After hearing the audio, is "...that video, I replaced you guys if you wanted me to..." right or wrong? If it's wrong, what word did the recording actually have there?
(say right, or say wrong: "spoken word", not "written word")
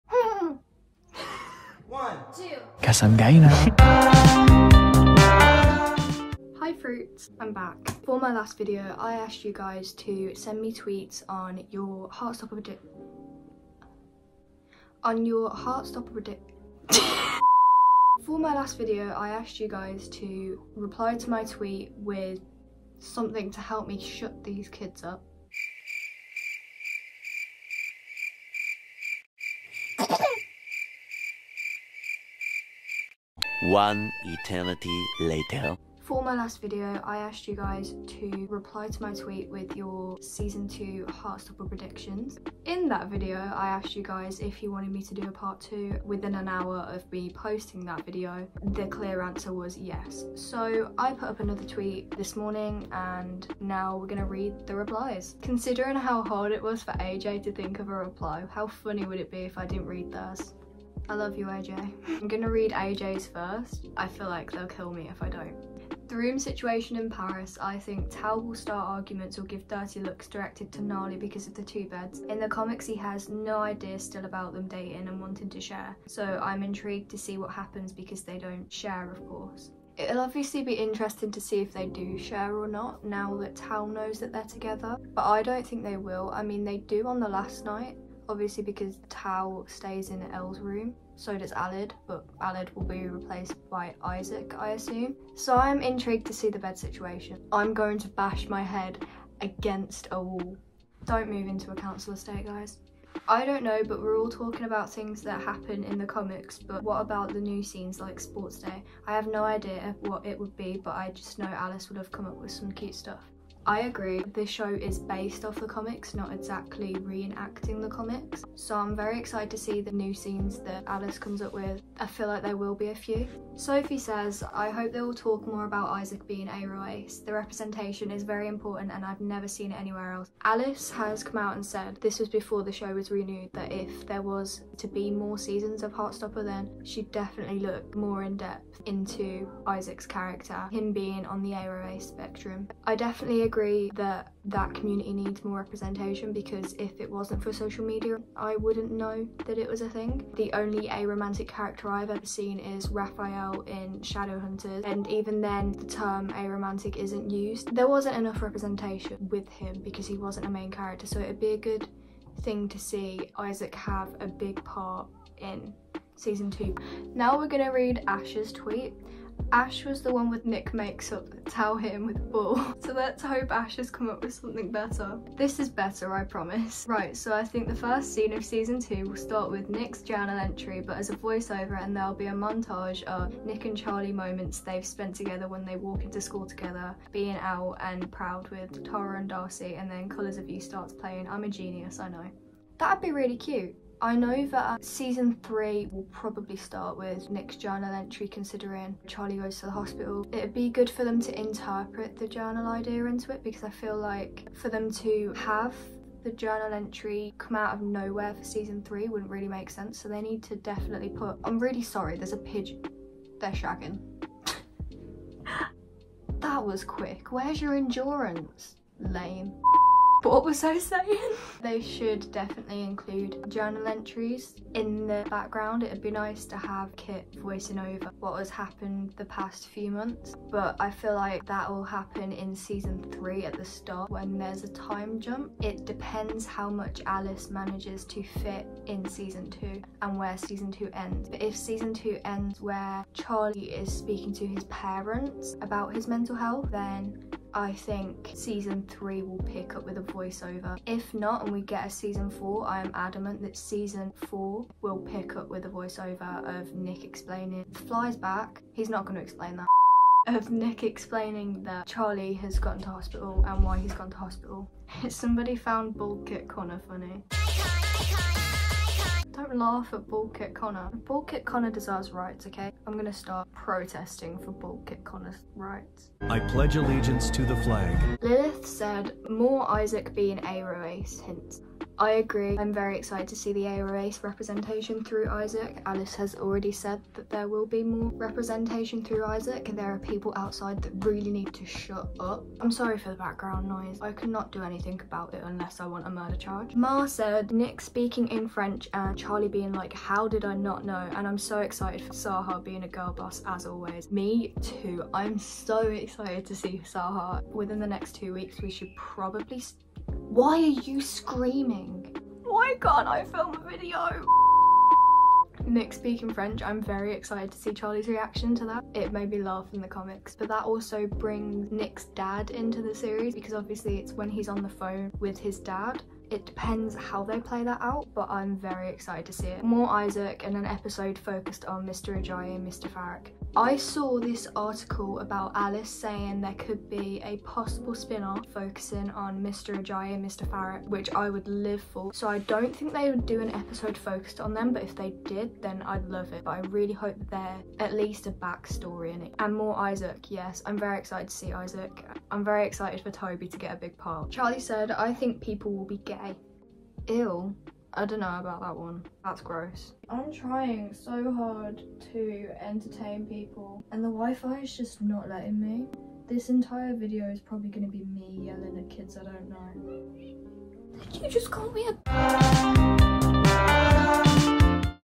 wrong: "asked", not "replaced".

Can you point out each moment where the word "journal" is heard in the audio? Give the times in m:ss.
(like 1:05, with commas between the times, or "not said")
3:00, 3:17, 3:22, 3:26, 3:43.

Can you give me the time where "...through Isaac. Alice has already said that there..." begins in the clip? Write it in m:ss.
4:45.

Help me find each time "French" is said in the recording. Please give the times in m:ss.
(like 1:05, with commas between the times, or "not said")
4:58, 5:16.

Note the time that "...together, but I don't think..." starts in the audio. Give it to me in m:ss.
1:24.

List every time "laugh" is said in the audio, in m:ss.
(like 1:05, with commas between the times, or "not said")
4:29, 5:19.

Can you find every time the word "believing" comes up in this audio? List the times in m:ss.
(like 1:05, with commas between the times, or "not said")
not said.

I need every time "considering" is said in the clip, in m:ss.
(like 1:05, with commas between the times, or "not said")
0:55, 3:18.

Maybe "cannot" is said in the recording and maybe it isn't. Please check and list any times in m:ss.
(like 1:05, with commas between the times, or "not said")
4:54.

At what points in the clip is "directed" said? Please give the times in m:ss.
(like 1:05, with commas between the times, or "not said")
1:10.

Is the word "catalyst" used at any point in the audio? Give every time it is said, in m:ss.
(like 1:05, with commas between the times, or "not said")
not said.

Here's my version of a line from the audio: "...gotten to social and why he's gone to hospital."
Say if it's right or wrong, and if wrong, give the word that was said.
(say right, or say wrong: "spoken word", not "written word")
wrong: "hospital", not "social".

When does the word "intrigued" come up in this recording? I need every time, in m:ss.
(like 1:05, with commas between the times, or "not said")
1:16, 1:35.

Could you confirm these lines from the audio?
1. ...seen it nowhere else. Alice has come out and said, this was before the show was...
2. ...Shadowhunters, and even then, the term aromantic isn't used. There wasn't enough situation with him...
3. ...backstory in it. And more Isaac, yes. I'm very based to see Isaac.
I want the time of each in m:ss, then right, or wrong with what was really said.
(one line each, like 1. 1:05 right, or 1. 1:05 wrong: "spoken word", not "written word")
1. 2:09 wrong: "anywhere", not "nowhere"
2. 2:33 wrong: "representation", not "situation"
3. 5:48 wrong: "excited", not "based".